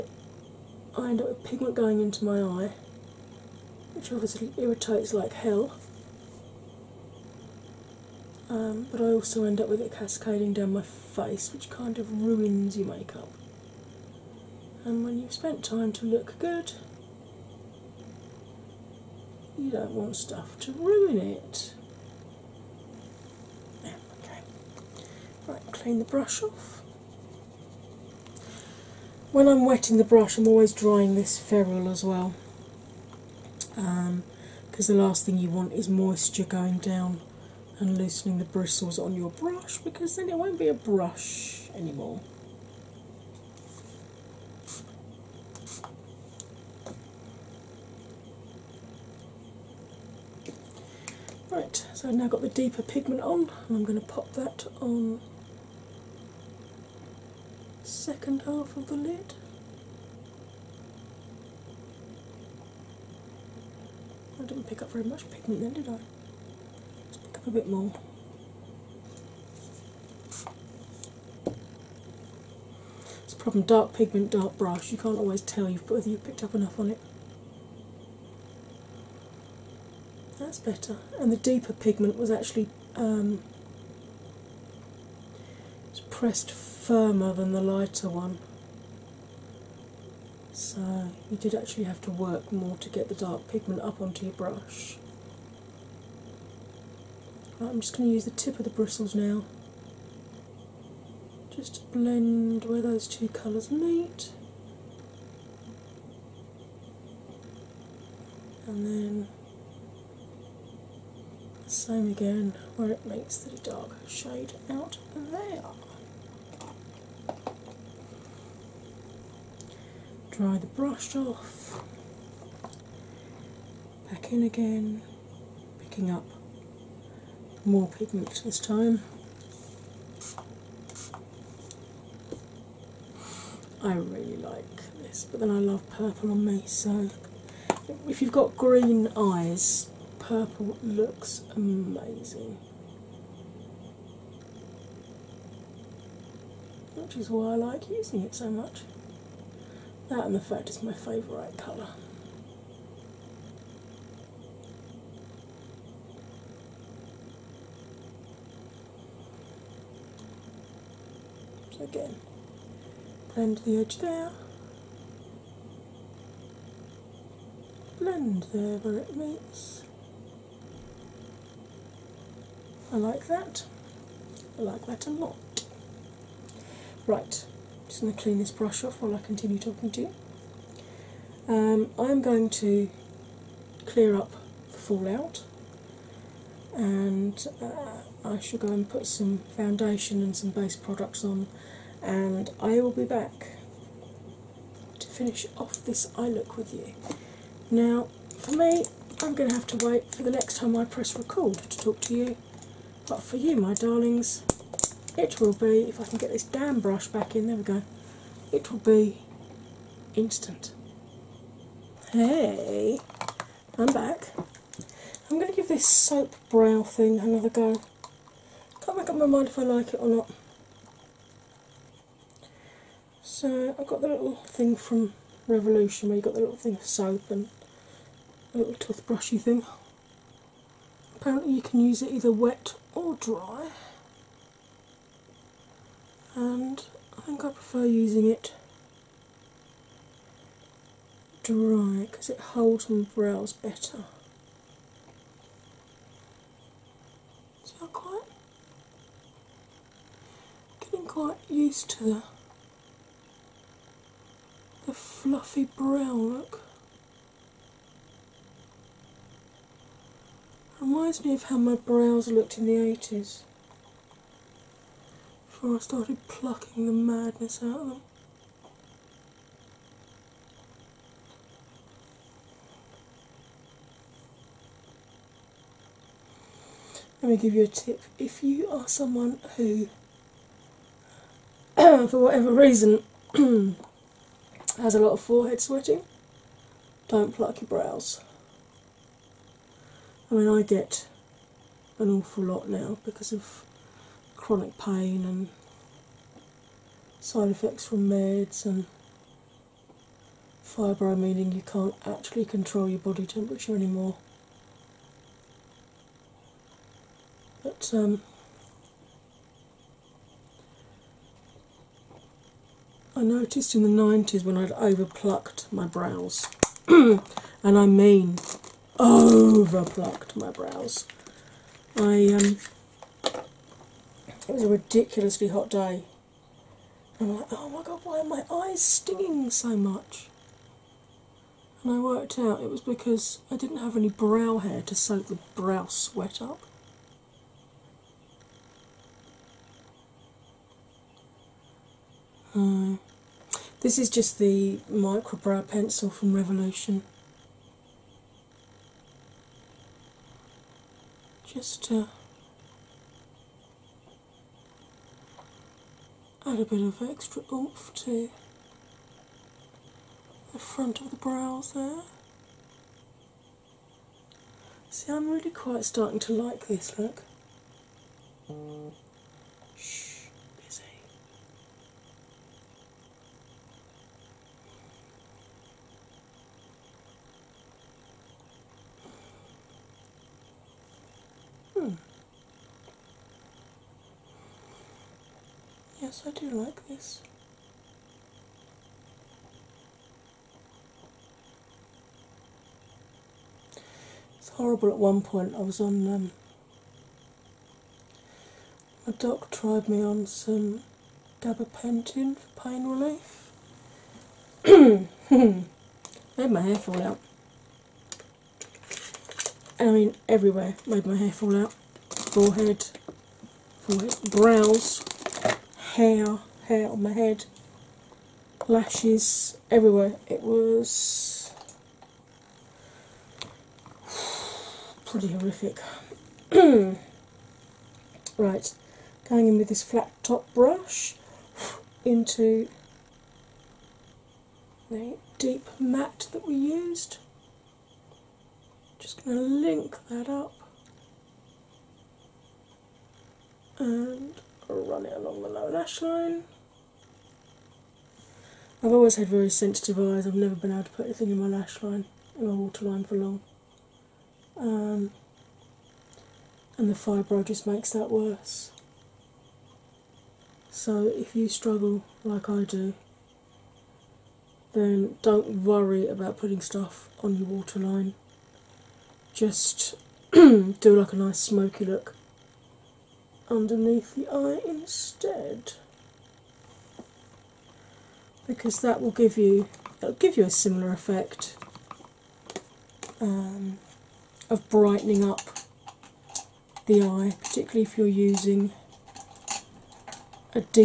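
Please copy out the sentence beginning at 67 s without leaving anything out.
Let's pick up a bit more.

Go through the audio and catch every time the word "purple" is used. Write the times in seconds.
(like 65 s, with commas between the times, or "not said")
135 s, 140 s.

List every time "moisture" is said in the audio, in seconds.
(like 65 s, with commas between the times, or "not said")
35 s.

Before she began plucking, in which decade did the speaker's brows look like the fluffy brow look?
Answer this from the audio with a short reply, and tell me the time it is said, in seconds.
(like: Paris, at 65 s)
the 80s, at 262 s.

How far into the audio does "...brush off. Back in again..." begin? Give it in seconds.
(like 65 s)
120 s.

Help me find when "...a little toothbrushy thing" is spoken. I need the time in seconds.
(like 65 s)
228 s.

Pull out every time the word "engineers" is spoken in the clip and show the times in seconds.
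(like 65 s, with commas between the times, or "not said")
not said.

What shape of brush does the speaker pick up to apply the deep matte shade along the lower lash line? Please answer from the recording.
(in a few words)
flat top brush.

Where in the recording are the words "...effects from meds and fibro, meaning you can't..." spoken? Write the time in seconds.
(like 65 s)
297 s.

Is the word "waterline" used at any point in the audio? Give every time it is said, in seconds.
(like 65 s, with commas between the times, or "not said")
452 s, 467 s.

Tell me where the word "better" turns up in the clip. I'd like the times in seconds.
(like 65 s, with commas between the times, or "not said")
80 s, 243 s.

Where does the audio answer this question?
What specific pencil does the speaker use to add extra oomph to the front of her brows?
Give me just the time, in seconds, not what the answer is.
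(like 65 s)
344 s.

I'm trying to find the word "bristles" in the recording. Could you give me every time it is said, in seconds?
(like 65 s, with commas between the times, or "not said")
38 s, 98 s.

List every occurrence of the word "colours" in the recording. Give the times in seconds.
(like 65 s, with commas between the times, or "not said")
103 s, 151 s.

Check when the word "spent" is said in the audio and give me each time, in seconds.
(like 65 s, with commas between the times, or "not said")
15 s.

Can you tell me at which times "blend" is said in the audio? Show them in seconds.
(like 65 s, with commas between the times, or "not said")
101 s, 163 s, 168 s.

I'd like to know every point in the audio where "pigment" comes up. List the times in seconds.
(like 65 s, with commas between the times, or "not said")
1 s, 52 s, 65 s, 73 s, 81 s, 93 s, 127 s.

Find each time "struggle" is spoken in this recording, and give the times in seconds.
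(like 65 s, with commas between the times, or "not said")
461 s.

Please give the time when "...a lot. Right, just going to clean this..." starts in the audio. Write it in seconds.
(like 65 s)
175 s.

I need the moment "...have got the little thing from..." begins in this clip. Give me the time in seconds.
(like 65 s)
223 s.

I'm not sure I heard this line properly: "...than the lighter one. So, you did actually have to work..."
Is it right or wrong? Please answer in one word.
right.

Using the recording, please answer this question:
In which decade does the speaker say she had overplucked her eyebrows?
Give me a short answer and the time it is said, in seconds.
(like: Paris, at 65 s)
the 90s, at 314 s.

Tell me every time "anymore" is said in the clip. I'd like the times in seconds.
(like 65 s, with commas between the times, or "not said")
41 s, 303 s.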